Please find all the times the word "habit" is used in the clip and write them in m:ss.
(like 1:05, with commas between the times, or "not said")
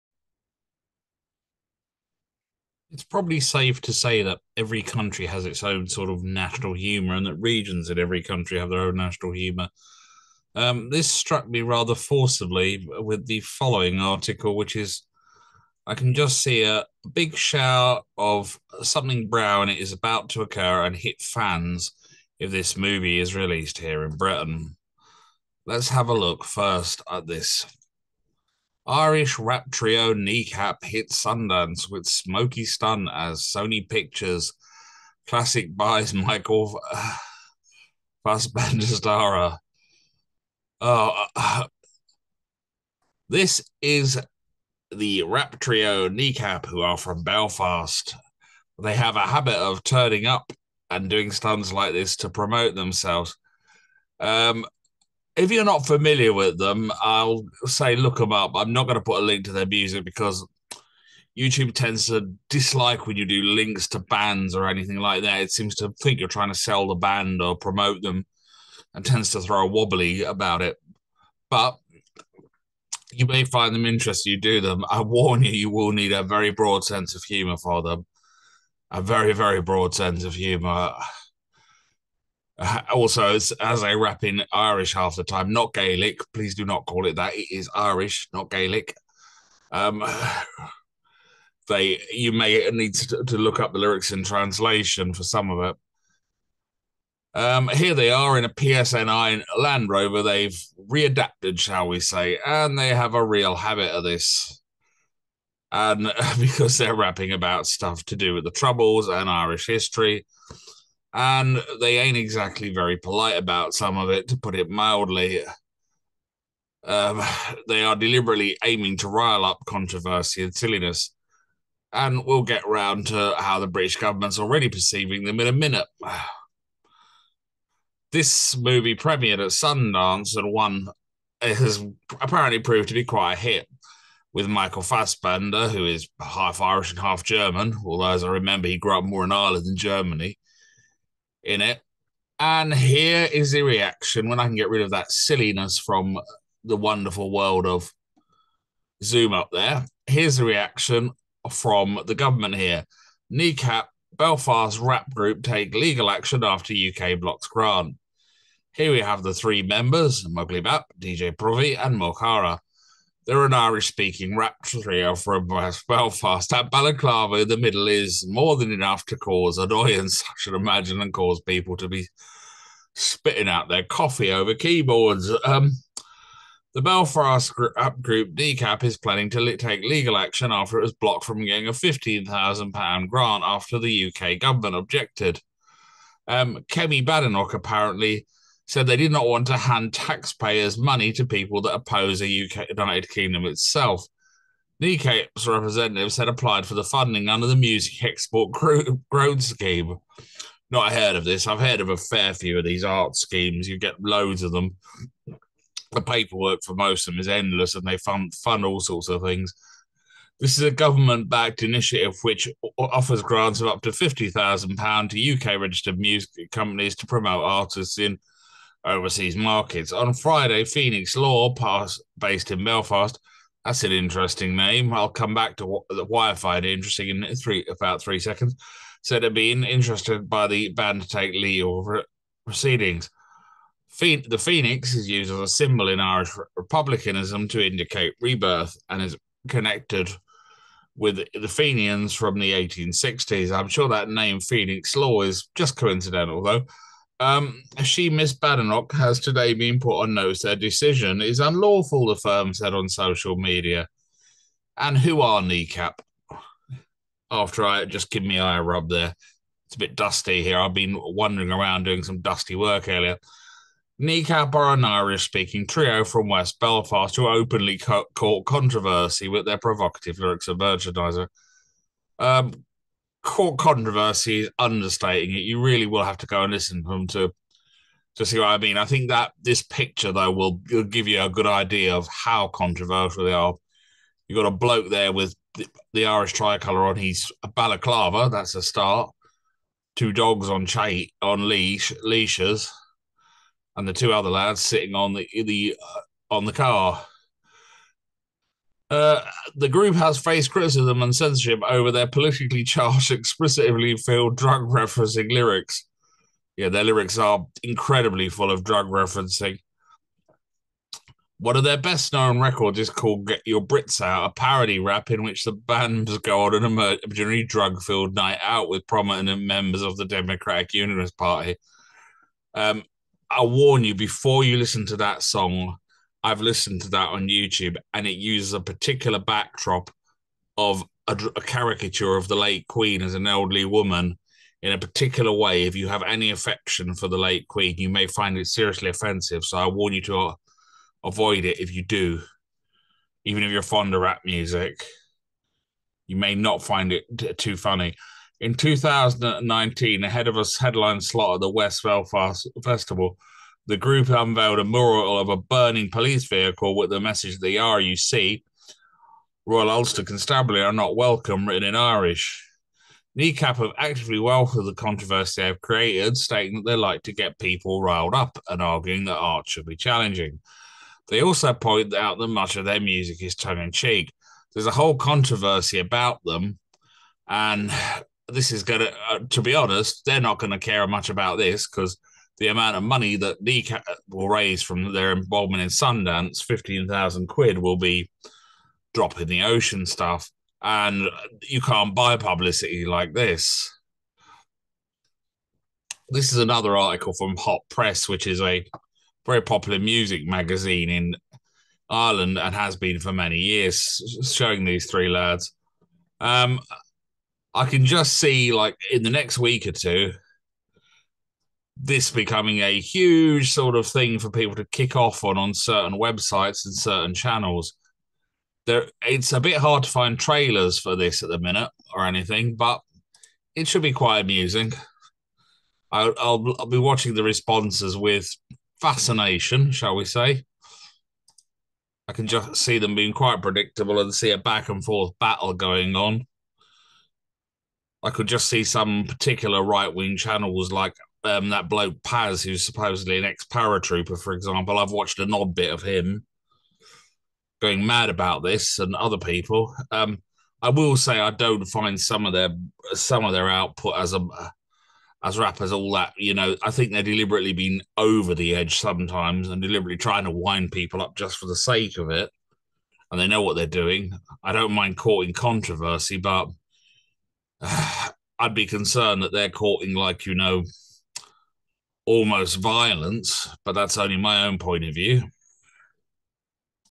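0:49, 1:43.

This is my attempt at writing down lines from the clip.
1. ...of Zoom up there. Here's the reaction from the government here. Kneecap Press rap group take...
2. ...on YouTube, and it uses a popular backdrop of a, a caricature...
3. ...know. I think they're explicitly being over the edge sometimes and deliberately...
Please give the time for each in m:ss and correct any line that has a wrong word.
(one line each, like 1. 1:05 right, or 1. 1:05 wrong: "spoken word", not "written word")
1. 2:27 wrong: "Belfast", not "Press"
2. 5:27 wrong: "particular", not "popular"
3. 7:36 wrong: "deliberately", not "explicitly".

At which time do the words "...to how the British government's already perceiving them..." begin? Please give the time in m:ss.
2:03.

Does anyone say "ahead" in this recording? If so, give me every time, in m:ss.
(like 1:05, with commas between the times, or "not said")
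5:50.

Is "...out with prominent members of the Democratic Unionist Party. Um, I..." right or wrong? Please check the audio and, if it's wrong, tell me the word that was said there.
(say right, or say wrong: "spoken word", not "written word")
right.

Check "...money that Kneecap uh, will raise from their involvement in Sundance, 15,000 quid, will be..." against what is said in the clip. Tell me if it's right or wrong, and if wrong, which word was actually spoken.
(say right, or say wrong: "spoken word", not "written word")
right.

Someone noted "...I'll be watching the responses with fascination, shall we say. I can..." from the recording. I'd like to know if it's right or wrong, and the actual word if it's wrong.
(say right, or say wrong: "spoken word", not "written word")
right.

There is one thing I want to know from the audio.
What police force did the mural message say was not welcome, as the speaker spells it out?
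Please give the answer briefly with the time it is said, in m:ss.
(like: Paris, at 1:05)
Royal Ulster Constabulary, at 5:59.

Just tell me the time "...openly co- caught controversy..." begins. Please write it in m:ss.
4:27.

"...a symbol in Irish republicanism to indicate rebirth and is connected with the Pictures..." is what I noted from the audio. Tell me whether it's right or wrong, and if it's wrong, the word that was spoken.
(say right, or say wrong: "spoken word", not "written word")
wrong: "Fenians", not "Pictures".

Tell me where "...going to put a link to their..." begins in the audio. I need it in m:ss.
0:58.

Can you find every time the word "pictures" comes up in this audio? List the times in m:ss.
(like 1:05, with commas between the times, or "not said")
0:33, 4:39.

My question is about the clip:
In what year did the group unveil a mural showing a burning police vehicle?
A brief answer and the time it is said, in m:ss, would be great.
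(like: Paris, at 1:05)
2019, at 5:48.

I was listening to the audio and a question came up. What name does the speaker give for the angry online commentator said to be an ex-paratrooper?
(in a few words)
Paz.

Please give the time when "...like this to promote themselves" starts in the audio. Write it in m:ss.
0:51.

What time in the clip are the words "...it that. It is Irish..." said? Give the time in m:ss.
1:27.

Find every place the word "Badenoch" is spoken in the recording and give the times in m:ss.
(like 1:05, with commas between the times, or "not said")
3:07, 4:08.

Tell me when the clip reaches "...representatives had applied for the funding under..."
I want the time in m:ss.
3:15.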